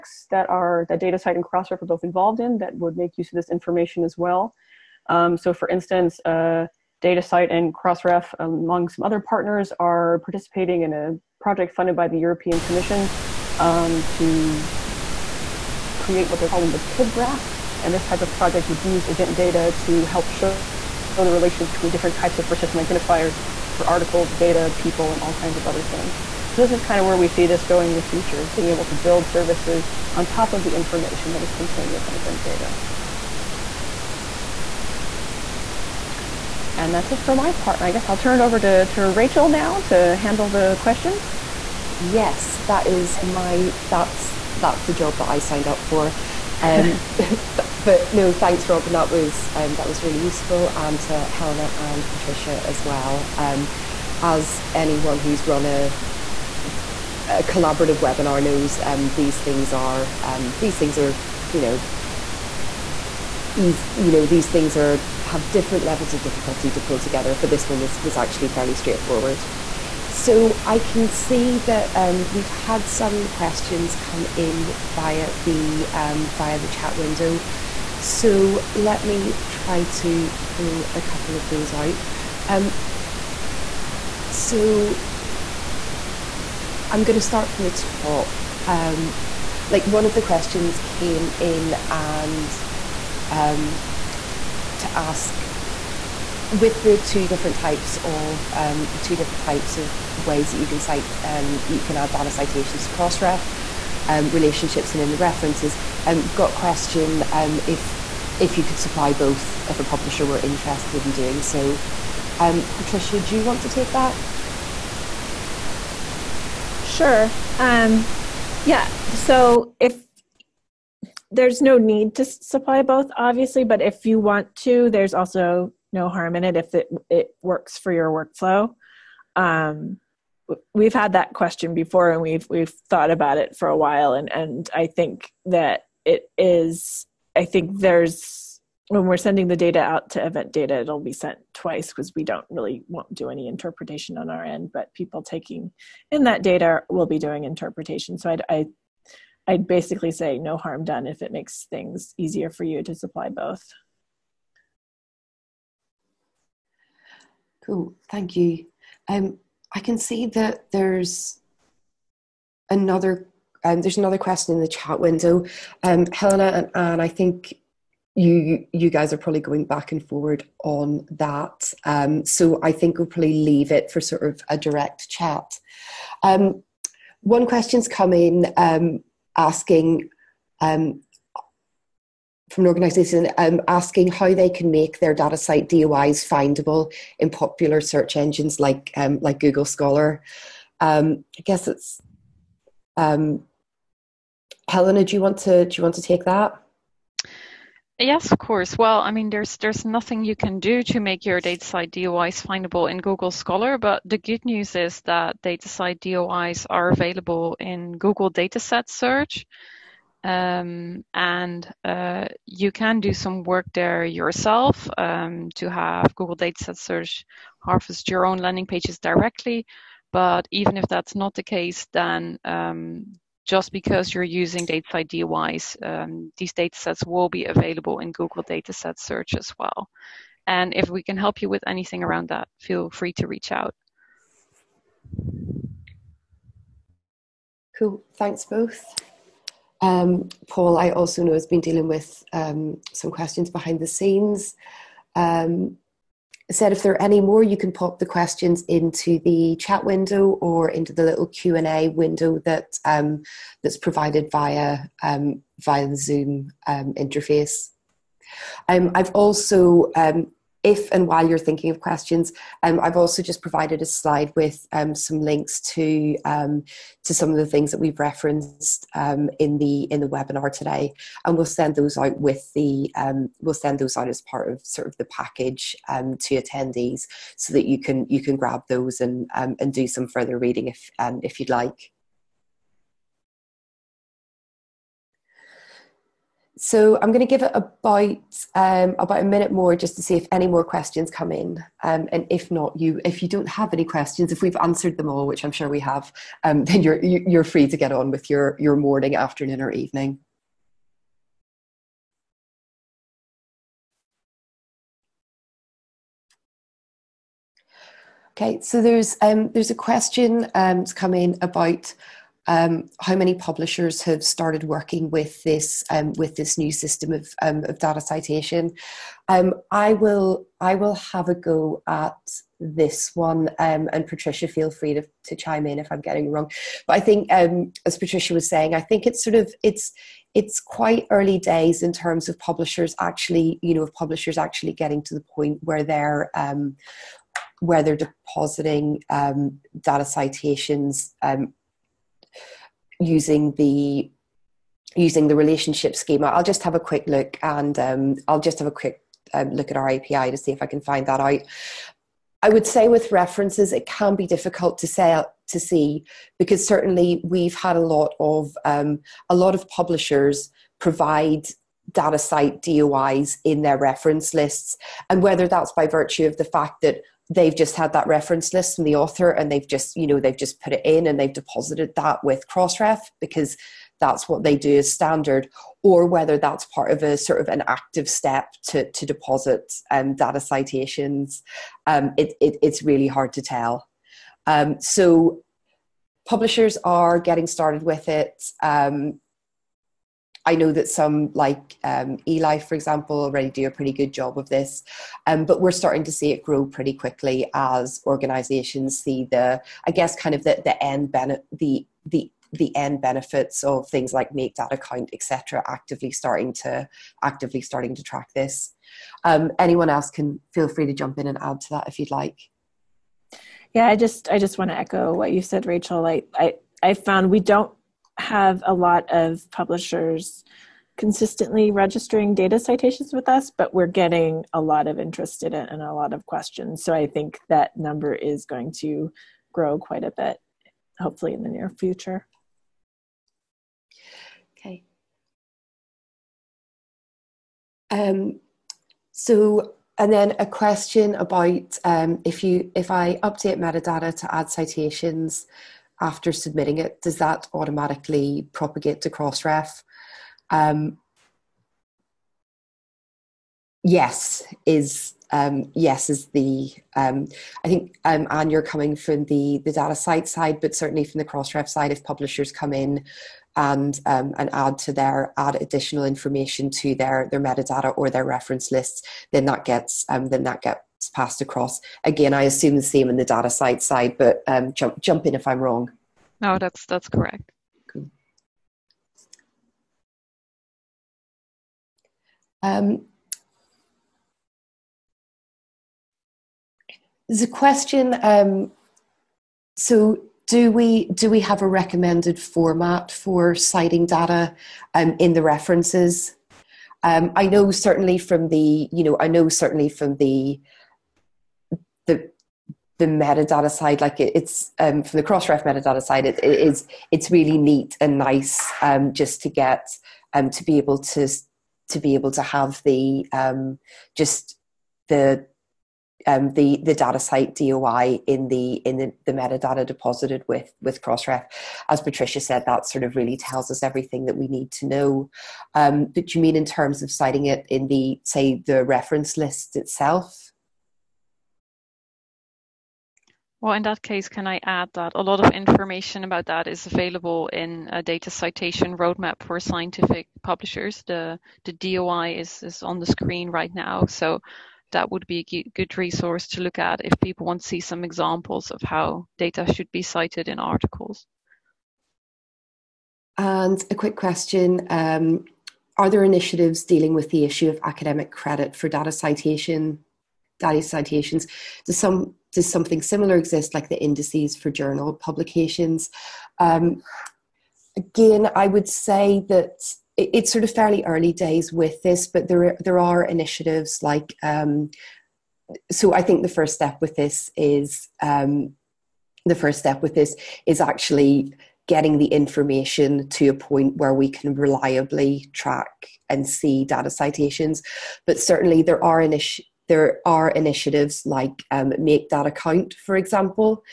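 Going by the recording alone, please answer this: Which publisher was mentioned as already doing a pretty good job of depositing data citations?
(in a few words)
Eli.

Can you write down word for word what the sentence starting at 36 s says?
And that's it for my part.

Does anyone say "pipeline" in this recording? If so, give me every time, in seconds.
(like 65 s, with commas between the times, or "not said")
not said.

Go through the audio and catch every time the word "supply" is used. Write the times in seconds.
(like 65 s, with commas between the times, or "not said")
108 s, 122 s, 152 s.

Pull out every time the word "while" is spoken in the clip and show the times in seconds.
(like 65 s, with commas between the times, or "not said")
133 s, 261 s.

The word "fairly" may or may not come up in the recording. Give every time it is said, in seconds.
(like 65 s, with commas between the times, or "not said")
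68 s, 570 s.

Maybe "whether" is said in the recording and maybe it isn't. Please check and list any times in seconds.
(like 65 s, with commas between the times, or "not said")
365 s, 376 s.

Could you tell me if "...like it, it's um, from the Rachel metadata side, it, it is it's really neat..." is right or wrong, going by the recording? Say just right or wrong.
wrong.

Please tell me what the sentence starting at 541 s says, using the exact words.
The, the DOI is, is on the screen right now.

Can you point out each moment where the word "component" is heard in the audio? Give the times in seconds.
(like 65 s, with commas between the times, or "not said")
not said.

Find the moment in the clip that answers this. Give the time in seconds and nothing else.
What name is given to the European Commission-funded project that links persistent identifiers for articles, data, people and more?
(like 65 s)
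16 s.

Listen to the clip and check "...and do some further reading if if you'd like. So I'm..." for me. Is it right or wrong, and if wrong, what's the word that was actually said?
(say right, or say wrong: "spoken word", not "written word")
right.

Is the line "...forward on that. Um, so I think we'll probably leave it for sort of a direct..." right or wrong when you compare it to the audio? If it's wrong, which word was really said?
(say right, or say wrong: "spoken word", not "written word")
right.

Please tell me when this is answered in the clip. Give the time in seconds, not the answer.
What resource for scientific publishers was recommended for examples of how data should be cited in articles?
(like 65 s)
538 s.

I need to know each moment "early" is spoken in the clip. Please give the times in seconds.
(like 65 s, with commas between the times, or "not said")
331 s, 571 s.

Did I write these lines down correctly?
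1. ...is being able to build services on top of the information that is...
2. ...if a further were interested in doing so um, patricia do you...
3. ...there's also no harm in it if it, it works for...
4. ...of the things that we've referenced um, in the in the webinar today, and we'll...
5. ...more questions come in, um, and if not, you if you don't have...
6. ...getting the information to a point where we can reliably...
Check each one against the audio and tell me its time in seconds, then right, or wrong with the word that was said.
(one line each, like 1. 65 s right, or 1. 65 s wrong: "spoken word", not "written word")
1. 28 s right
2. 109 s wrong: "publisher", not "further"
3. 124 s right
4. 267 s right
5. 290 s right
6. 581 s right.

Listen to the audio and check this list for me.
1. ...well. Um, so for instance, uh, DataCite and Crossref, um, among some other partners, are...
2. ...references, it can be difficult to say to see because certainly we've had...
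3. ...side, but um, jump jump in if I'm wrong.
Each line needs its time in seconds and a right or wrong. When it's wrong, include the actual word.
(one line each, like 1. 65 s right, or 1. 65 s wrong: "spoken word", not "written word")
1. 4 s right
2. 353 s right
3. 473 s right.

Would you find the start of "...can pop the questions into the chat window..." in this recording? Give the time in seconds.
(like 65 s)
247 s.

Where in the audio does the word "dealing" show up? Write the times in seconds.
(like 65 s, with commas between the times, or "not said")
241 s, 556 s.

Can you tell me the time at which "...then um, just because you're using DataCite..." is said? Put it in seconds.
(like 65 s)
221 s.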